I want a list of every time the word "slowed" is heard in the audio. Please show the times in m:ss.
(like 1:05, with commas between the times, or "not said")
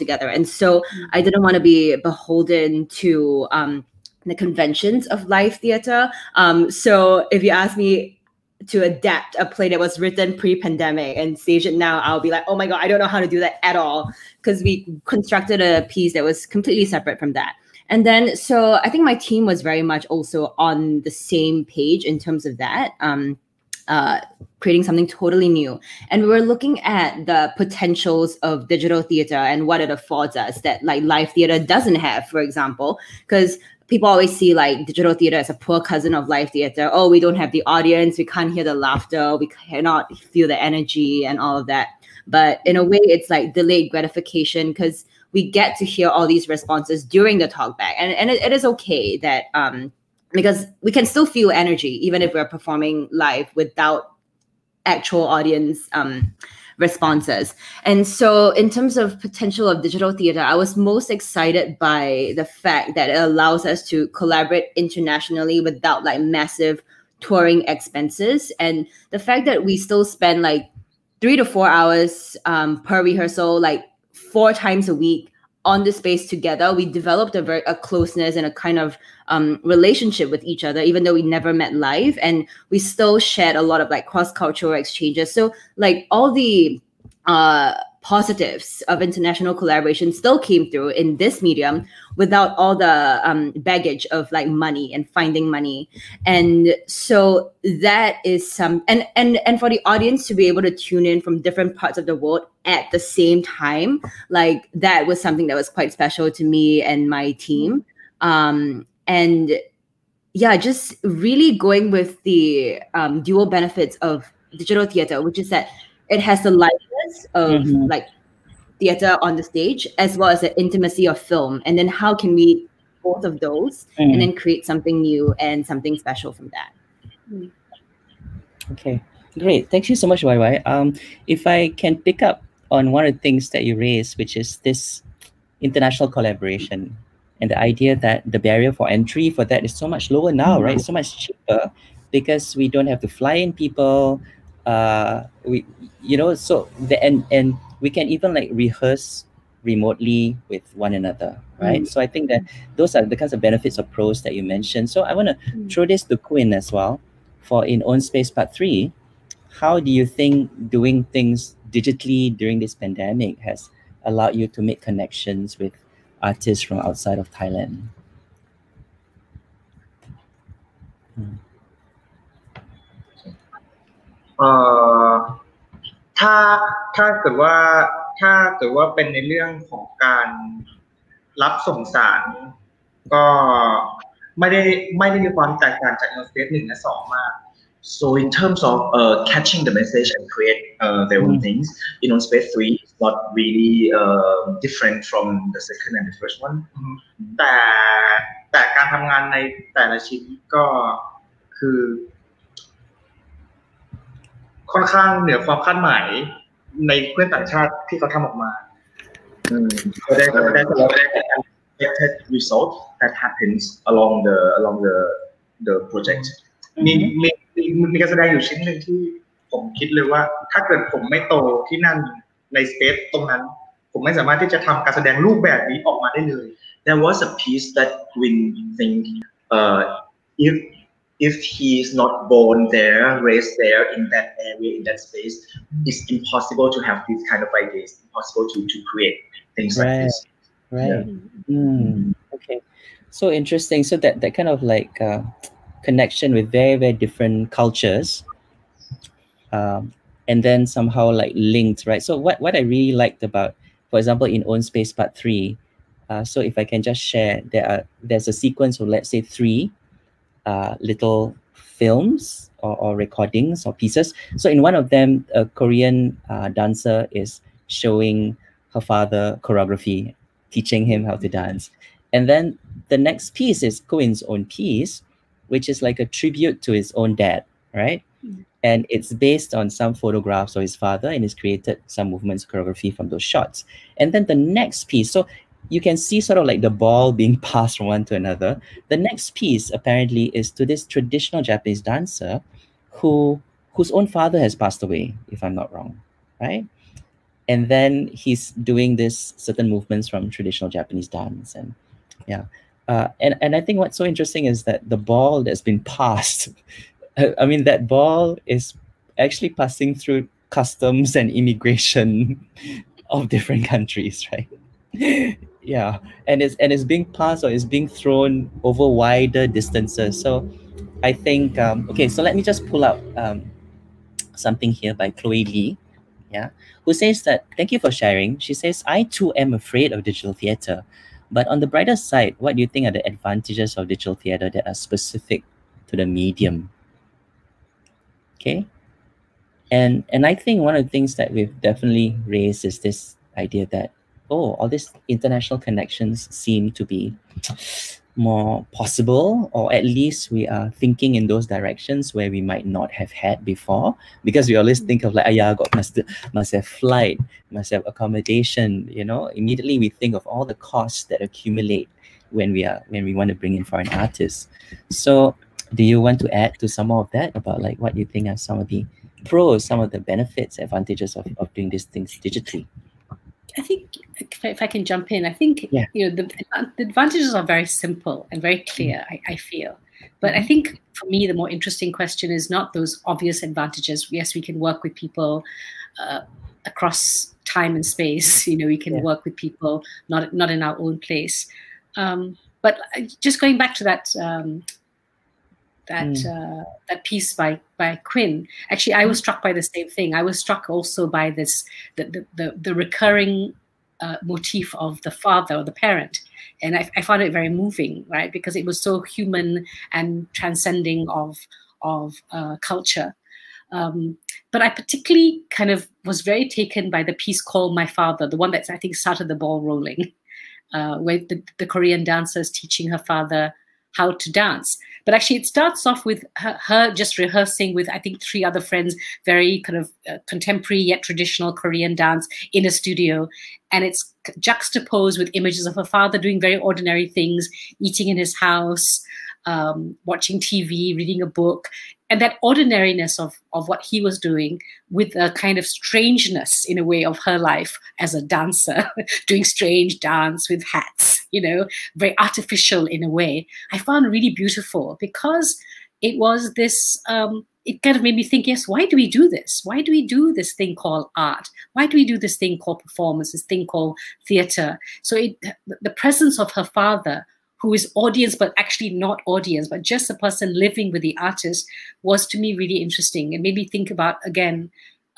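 not said.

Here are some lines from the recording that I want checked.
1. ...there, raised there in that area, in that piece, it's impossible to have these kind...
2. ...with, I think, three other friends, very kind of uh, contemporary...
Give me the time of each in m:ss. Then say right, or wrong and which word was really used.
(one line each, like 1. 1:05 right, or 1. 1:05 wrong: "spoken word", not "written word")
1. 3:52 wrong: "space", not "piece"
2. 7:07 right.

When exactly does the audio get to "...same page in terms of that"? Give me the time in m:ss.
0:21.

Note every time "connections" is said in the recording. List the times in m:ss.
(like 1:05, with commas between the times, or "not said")
2:44, 4:05, 5:45.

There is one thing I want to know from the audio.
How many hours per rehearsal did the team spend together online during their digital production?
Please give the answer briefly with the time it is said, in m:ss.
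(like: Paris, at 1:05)
3 to 4 hours, at 1:11.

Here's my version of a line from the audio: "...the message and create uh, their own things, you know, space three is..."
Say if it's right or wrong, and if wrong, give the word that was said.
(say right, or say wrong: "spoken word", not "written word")
right.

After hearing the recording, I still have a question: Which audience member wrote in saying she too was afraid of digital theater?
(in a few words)
Chloe Lee.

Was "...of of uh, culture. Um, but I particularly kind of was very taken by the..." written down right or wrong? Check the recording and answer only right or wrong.
right.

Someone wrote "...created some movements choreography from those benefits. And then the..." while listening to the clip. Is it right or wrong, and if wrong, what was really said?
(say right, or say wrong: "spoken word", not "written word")
wrong: "shots", not "benefits".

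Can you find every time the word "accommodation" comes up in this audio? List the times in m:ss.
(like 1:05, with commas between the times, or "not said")
5:57.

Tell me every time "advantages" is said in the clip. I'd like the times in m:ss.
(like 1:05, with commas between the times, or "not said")
5:33, 6:10, 6:16, 6:23.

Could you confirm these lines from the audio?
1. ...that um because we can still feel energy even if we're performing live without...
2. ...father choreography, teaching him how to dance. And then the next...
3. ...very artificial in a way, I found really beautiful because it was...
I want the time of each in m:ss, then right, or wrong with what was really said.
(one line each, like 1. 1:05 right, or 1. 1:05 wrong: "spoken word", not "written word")
1. 0:49 right
2. 4:28 right
3. 7:31 right.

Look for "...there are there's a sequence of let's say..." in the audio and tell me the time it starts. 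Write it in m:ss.
4:17.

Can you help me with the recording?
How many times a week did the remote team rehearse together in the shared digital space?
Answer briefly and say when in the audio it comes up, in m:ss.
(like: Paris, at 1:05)
4 times, at 1:14.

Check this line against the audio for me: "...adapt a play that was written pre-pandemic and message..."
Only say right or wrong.
wrong.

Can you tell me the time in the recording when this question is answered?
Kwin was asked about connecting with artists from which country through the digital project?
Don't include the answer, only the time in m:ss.
2:47.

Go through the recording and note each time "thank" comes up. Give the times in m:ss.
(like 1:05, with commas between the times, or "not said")
2:09, 5:27.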